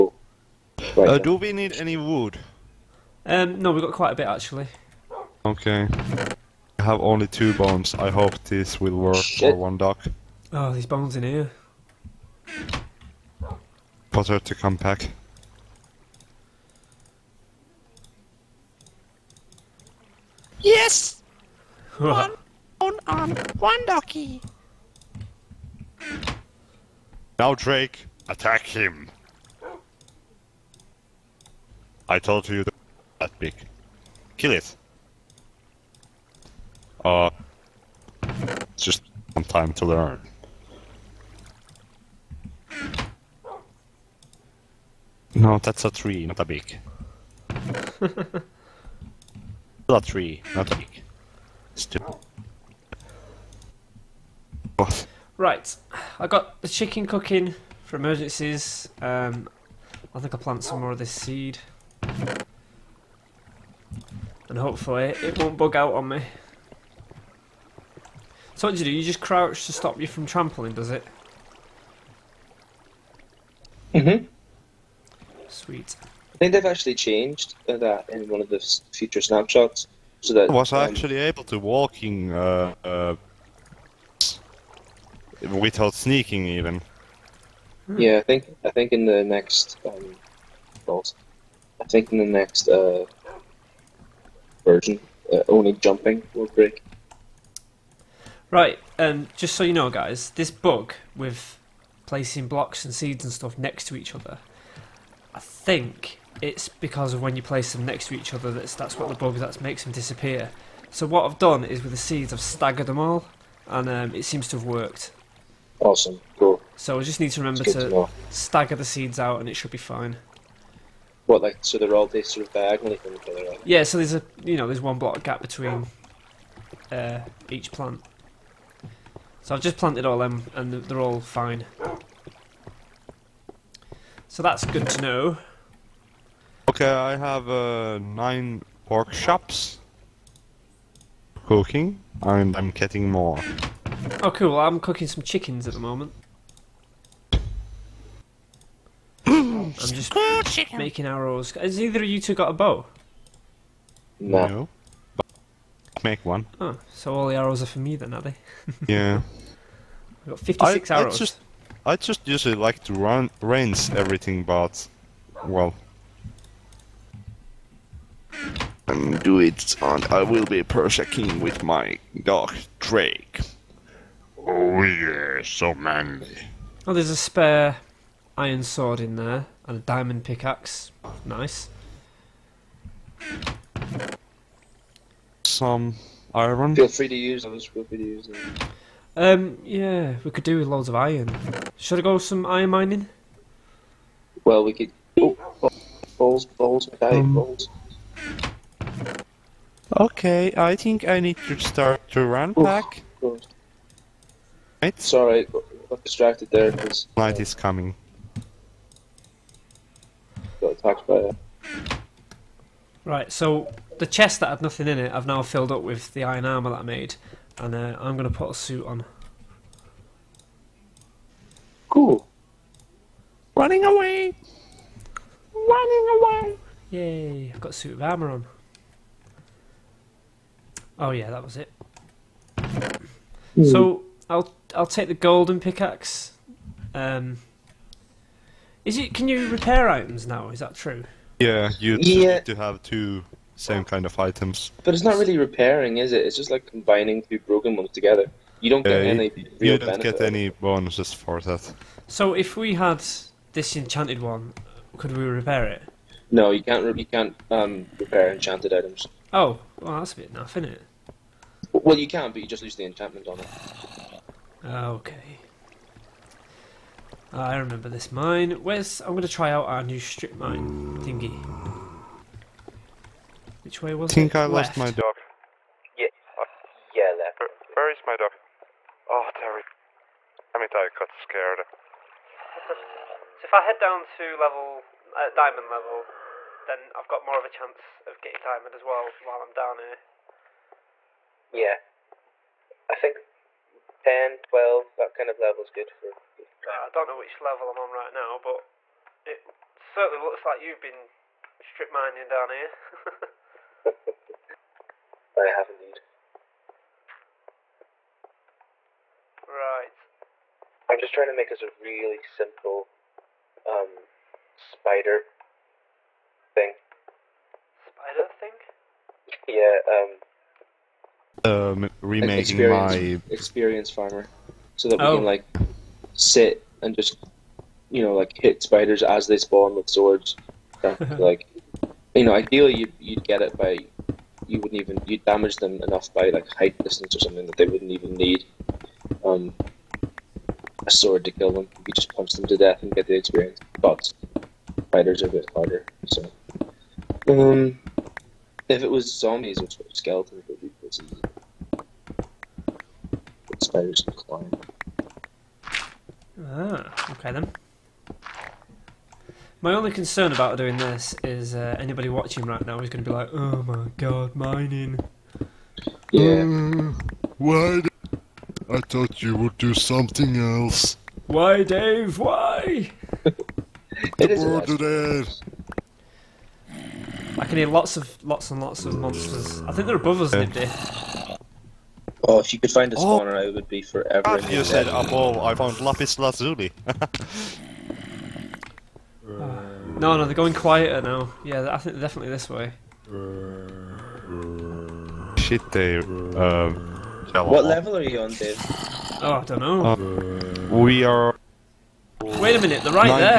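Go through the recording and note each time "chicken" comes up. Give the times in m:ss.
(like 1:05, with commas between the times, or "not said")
0:56, 2:25.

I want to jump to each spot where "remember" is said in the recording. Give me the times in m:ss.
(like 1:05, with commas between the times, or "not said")
1:57, 4:27.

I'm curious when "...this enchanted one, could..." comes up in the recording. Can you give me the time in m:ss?
4:13.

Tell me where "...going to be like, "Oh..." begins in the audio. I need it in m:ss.
6:02.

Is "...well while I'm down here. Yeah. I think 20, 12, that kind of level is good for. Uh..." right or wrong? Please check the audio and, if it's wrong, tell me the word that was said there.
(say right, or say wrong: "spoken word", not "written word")
wrong: "10", not "20".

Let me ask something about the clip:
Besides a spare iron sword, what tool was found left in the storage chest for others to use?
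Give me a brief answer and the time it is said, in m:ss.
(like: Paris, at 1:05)
Diamond pickaxe, at 2:59.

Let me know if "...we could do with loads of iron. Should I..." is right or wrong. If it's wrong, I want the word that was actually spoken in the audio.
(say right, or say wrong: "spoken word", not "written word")
right.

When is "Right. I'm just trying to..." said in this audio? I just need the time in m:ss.
5:09.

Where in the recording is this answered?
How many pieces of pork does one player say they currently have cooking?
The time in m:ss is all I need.
2:17.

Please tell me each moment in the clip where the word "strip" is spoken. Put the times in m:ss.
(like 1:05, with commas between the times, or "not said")
4:29, 5:01.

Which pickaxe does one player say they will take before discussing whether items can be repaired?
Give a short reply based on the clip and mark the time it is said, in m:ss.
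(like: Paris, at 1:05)
Golden pickaxe, at 3:55.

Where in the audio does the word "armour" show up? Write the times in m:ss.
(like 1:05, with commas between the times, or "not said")
3:36, 3:48.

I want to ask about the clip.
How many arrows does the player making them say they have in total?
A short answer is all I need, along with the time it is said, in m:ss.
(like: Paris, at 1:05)
56, at 2:40.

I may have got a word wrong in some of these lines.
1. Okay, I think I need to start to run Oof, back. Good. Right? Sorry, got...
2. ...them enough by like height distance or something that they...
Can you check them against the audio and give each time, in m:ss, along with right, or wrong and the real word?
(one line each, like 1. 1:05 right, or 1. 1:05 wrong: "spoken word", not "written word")
1. 3:19 right
2. 5:35 right.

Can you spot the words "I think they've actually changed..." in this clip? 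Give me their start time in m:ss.
1:16.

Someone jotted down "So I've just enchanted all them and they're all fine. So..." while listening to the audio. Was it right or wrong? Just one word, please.
wrong.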